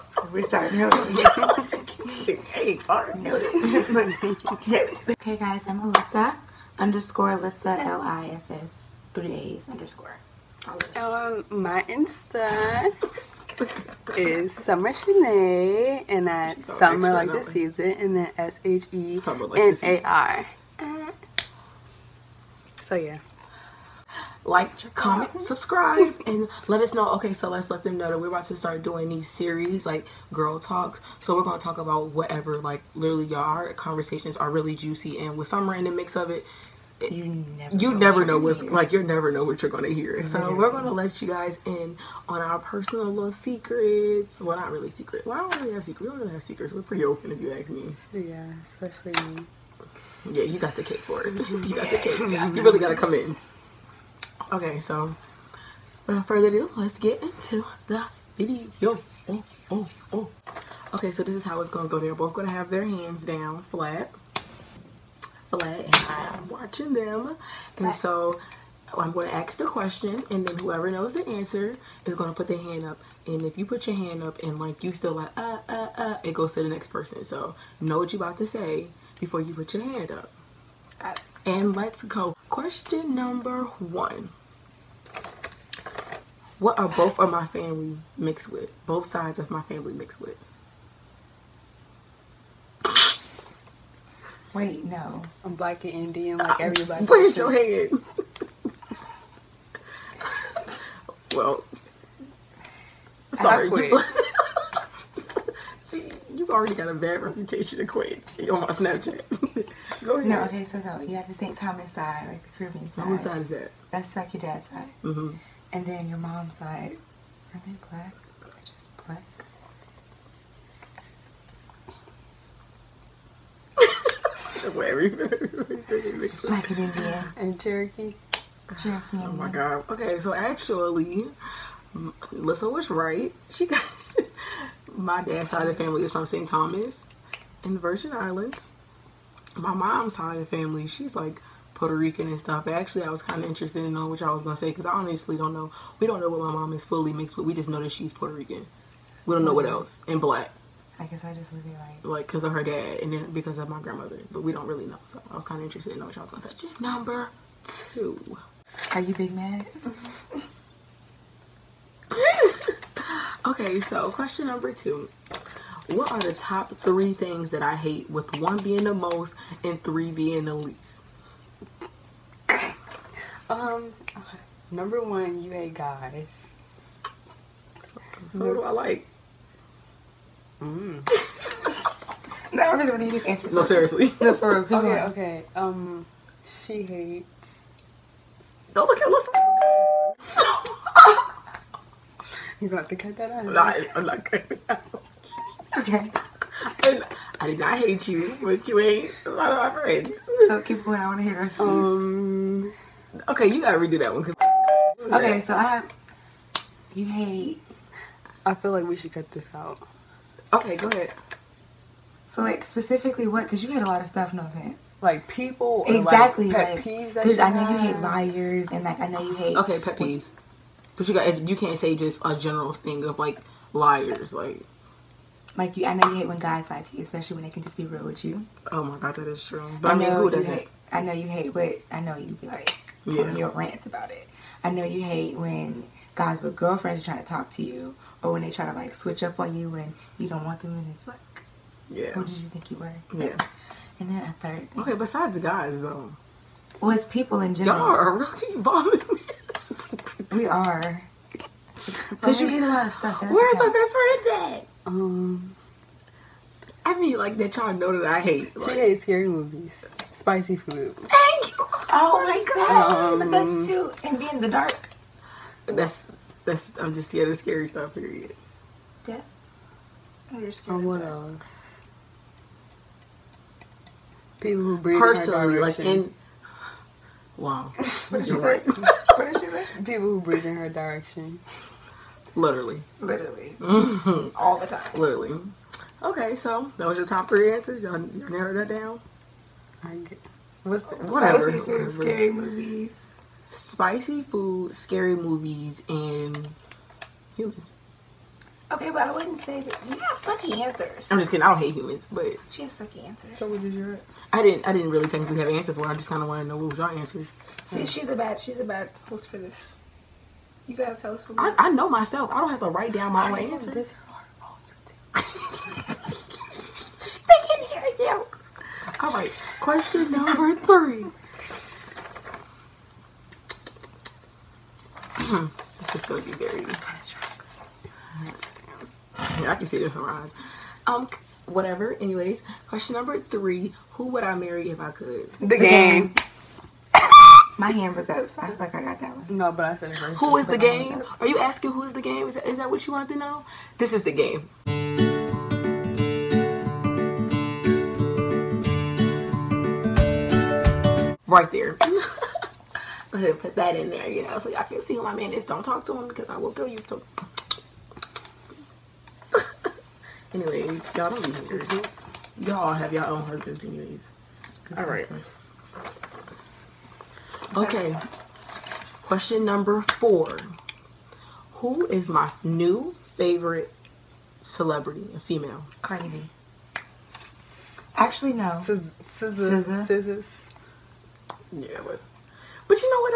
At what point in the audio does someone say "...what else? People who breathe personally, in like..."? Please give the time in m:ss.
4:30.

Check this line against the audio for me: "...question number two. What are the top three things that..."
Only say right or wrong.
right.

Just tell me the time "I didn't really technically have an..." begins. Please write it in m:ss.
5:04.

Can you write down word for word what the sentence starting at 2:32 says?
Like, because of her dad and then because of my grandmother.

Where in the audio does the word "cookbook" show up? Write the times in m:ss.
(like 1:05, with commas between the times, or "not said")
not said.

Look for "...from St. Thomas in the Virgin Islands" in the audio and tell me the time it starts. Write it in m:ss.
2:16.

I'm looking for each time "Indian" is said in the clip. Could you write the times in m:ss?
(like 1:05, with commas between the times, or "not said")
1:35, 2:06.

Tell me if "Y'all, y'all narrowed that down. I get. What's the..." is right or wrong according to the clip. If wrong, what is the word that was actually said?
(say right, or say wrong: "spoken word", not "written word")
right.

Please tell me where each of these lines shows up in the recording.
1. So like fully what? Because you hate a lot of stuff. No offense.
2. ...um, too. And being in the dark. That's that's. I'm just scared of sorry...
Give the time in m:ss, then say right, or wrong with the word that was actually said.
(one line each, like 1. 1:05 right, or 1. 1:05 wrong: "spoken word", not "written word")
1. 3:32 wrong: "specifically", not "fully"
2. 4:23 wrong: "scary", not "sorry".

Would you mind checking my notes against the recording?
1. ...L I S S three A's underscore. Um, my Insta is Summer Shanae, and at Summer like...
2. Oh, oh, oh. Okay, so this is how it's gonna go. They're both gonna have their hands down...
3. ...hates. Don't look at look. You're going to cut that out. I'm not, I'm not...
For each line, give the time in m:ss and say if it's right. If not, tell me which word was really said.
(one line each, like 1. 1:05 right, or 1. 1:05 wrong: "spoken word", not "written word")
1. 0:07 right
2. 0:59 right
3. 3:06 right.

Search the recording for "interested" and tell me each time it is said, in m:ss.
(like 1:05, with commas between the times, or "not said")
2:23, 2:35.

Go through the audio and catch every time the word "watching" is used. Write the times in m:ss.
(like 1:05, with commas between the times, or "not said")
1:06.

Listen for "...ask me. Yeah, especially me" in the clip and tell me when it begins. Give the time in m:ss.
0:47.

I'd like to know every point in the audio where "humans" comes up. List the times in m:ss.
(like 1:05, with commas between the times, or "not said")
4:57, 5:01.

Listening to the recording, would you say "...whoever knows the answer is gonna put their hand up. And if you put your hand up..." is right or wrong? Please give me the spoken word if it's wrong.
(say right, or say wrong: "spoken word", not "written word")
right.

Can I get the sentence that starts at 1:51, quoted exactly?
Thomas side, like the Caribbean side.